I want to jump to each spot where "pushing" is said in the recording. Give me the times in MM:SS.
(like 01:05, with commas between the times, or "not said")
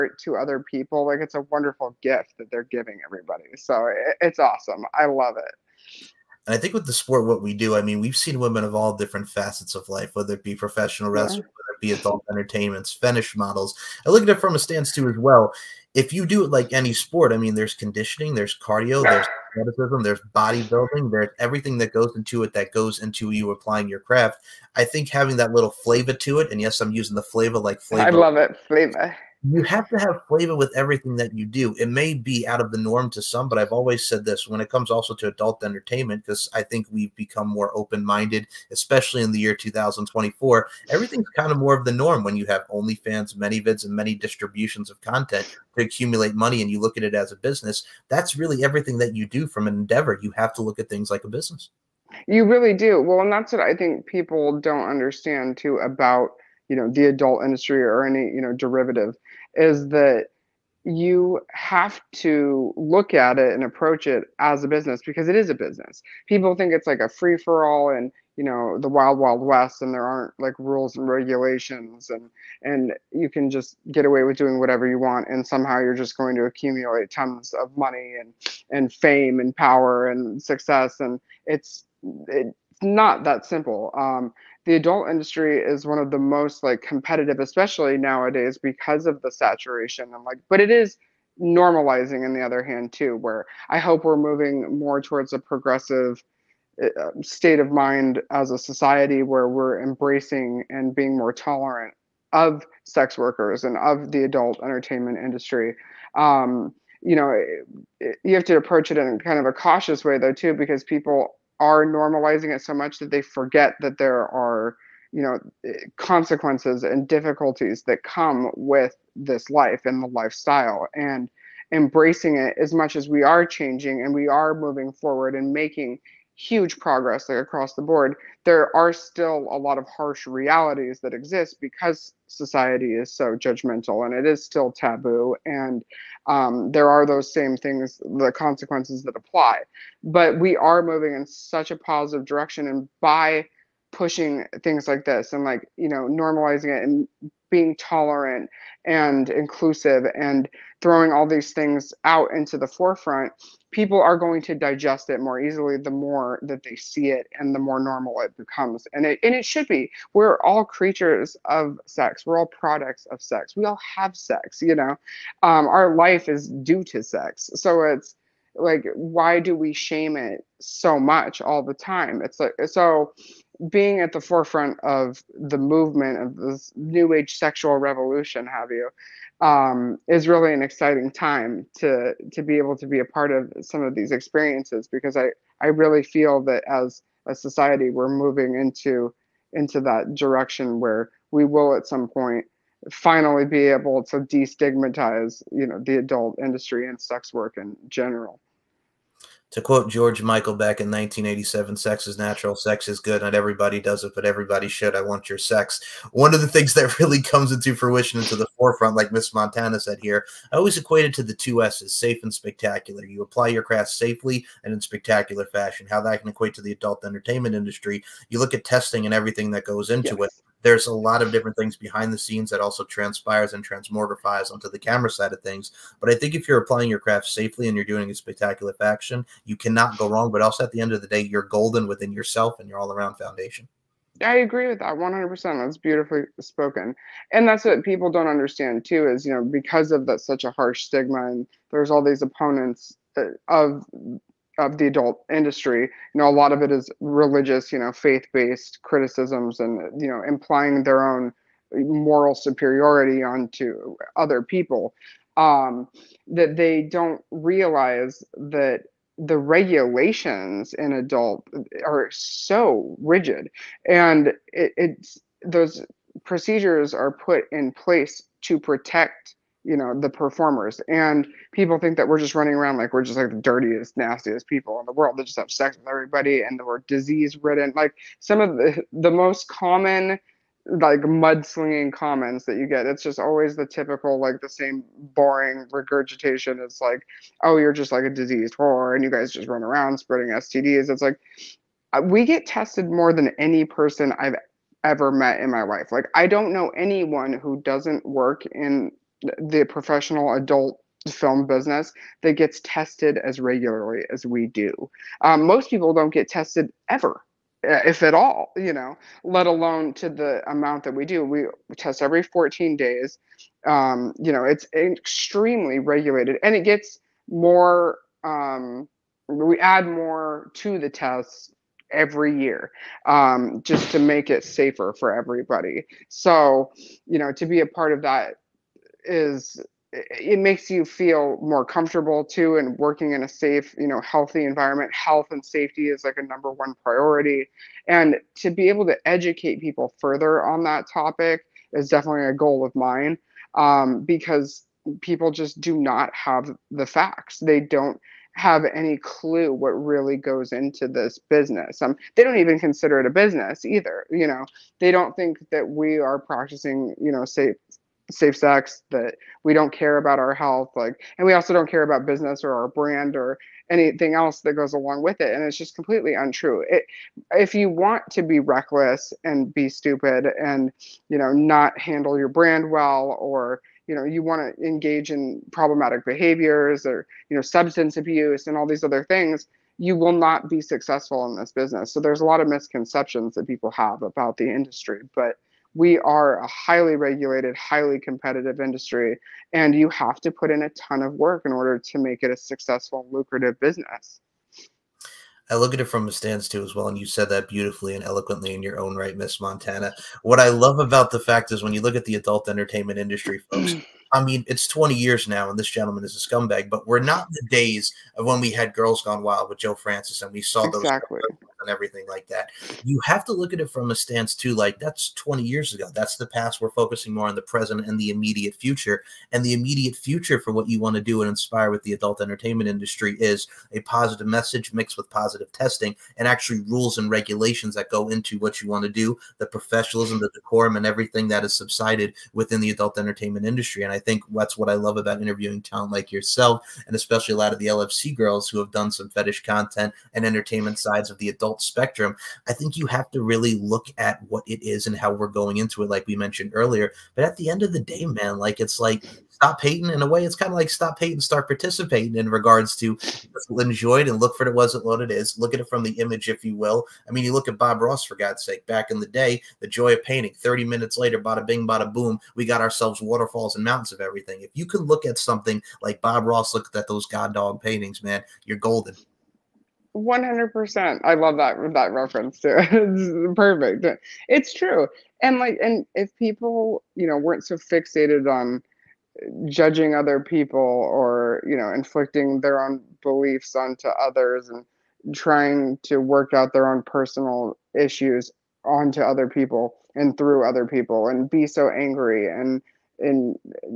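02:23.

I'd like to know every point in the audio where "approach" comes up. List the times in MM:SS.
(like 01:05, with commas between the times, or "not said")
01:03, 01:48.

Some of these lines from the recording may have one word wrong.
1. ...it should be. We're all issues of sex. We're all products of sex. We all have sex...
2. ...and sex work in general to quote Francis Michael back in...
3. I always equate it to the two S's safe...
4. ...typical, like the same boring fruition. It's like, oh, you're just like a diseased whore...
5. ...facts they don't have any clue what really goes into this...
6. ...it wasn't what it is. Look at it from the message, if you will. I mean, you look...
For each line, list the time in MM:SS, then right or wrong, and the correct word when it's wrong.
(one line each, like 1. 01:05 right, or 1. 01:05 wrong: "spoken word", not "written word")
1. 02:39 wrong: "creatures", not "issues"
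2. 03:16 wrong: "George", not "Francis"
3. 03:30 right
4. 04:43 wrong: "regurgitation", not "fruition"
5. 05:46 right
6. 07:34 wrong: "image", not "message".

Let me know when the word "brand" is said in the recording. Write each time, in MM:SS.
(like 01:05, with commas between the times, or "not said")
06:02, 06:12.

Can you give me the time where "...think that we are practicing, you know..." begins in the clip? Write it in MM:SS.
05:55.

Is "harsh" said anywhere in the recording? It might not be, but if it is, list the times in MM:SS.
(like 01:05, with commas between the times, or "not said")
02:09, 04:00.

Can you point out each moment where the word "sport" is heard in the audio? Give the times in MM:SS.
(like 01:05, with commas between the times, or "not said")
00:06, 00:16.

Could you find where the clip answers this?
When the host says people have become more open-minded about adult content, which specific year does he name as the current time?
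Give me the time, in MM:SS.
00:39.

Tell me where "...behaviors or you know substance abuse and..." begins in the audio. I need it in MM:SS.
06:16.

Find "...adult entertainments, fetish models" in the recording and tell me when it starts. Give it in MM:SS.
00:11.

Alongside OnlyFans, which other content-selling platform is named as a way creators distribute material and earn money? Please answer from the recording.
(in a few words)
ManyVids.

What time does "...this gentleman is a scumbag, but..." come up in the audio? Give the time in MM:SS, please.
06:45.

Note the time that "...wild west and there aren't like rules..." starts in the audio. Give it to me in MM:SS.
01:09.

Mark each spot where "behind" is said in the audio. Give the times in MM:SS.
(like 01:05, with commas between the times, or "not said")
03:41.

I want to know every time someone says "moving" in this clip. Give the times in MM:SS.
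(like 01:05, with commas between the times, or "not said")
01:34, 02:04, 02:20, 03:08.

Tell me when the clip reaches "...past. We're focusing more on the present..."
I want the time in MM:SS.
06:56.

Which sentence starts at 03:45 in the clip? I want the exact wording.
But I think if you're applying your craft safely and you're doing a spectacular fashion, you cannot go wrong.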